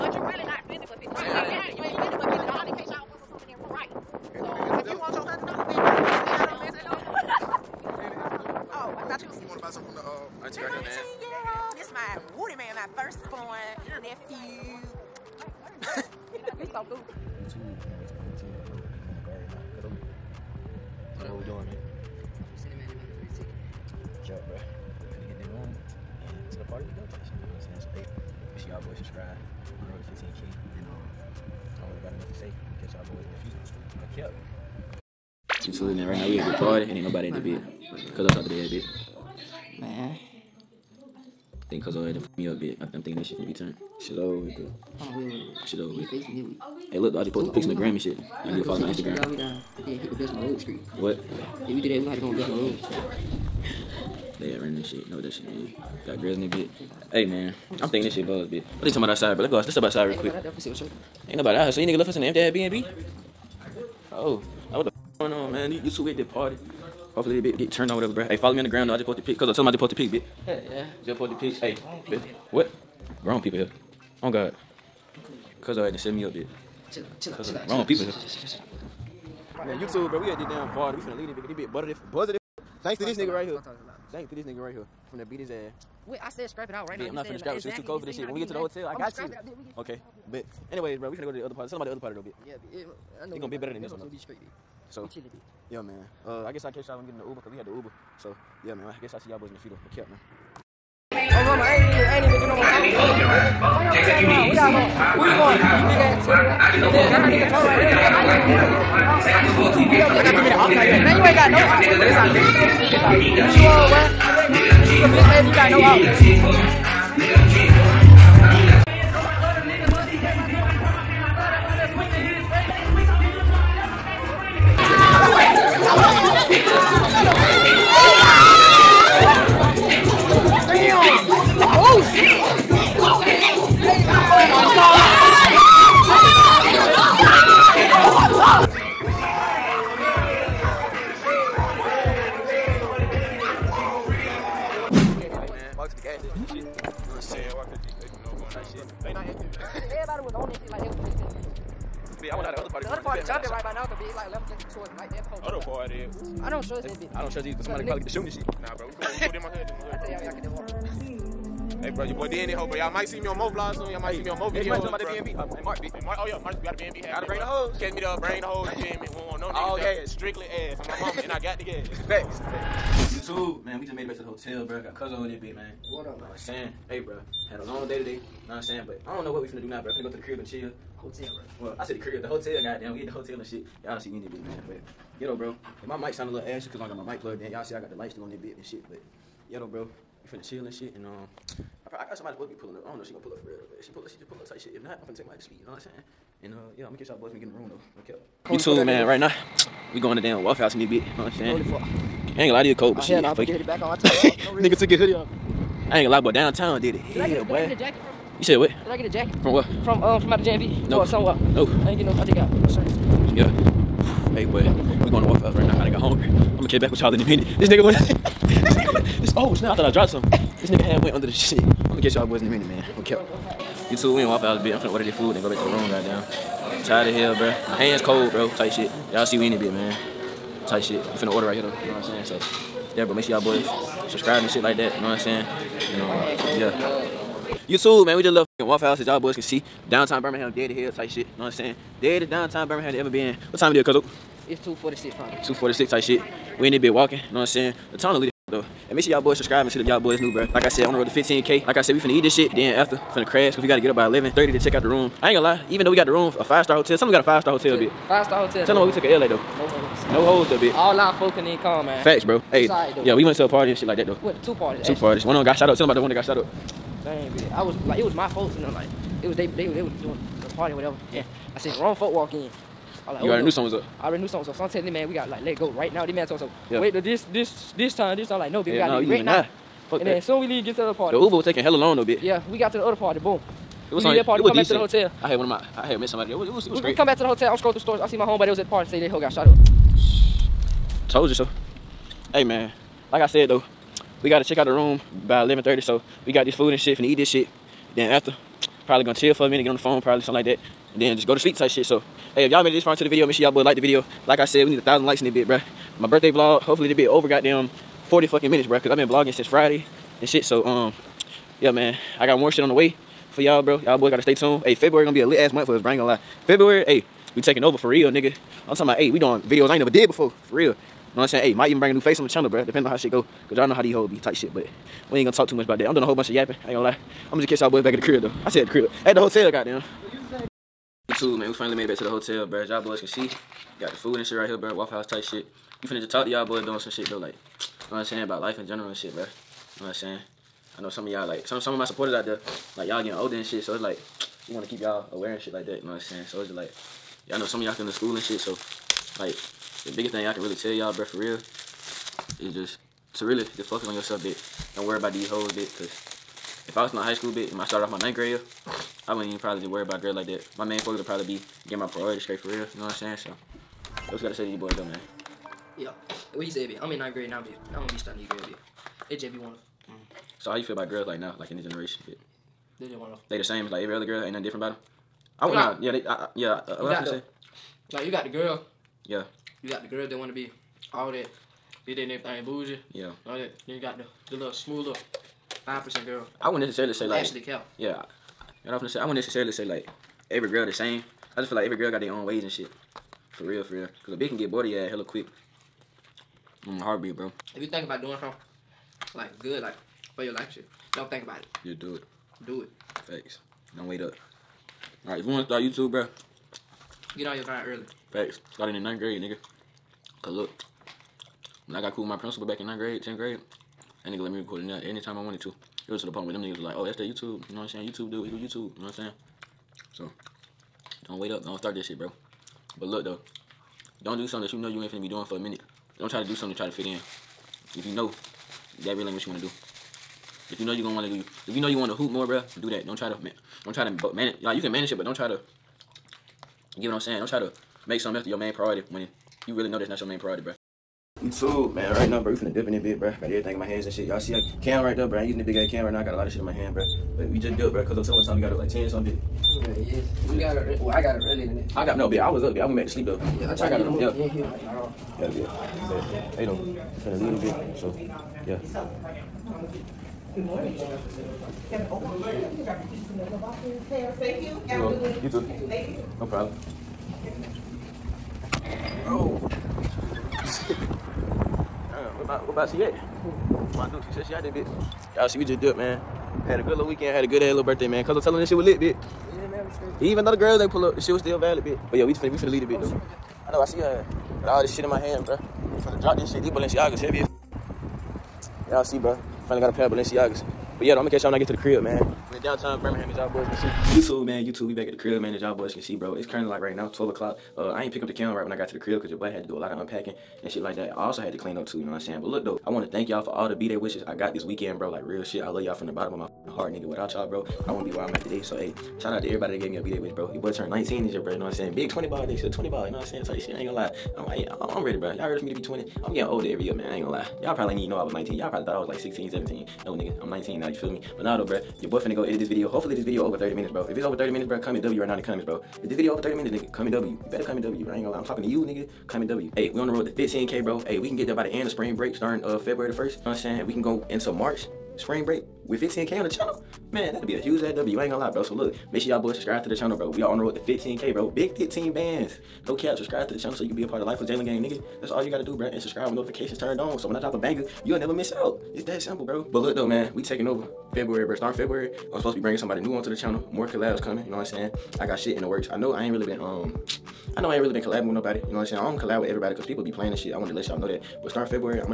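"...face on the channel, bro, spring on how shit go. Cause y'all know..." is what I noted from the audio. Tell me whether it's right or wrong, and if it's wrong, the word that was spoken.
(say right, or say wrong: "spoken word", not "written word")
wrong: "depending", not "spring".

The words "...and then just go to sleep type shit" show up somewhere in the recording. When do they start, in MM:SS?
05:00.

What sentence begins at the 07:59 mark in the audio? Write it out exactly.
Even though the girls ain't pull up, the shit was still valid, bitch.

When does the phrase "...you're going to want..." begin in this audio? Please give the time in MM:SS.
07:10.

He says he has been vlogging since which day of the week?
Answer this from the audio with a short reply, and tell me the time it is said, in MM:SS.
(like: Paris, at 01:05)
Friday, at 05:09.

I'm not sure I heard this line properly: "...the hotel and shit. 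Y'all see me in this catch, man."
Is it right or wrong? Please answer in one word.
wrong.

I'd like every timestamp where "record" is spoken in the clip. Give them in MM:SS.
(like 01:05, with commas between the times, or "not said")
06:54.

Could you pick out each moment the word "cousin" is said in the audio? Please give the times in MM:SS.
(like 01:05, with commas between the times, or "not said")
02:54.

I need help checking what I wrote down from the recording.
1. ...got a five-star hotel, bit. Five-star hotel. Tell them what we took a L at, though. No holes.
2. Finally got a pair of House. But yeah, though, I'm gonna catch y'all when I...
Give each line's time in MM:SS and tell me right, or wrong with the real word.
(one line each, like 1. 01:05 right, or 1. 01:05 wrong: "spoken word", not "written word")
1. 04:17 right
2. 08:09 wrong: "Balenciagas", not "House".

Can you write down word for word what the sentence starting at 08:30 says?
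Your boy turned 19 this year, bro, you know what I'm saying?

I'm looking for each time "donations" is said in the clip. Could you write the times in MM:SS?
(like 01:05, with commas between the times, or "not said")
not said.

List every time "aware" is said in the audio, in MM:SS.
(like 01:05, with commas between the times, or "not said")
05:45.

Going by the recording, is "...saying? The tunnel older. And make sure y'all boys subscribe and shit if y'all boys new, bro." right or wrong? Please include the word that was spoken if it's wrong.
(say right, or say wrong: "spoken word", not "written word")
wrong: "leader", not "older".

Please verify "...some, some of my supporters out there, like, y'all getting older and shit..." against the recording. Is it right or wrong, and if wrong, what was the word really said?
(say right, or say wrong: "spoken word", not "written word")
right.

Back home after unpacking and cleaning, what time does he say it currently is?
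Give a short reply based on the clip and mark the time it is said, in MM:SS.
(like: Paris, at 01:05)
12 o'clock, at 08:16.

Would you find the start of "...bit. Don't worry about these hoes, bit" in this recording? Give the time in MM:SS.
05:54.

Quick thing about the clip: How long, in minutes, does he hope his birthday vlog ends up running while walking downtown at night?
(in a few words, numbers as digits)
40.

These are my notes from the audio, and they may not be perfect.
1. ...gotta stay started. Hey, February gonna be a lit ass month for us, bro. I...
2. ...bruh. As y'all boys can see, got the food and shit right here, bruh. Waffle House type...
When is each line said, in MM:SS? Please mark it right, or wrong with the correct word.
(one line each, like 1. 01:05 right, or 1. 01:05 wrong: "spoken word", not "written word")
1. 05:14 wrong: "tuned", not "started"
2. 05:32 right.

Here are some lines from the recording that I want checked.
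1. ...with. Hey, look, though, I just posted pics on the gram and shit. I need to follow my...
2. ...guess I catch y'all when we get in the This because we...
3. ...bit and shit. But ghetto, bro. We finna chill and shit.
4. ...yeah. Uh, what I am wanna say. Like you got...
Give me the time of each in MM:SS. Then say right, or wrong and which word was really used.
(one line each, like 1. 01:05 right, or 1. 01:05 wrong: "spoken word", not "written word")
1. 00:45 right
2. 01:36 wrong: "Uber", not "This"
3. 03:08 right
4. 06:16 wrong: "gonna", not "wanna".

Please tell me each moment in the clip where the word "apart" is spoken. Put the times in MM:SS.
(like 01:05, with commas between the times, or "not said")
not said.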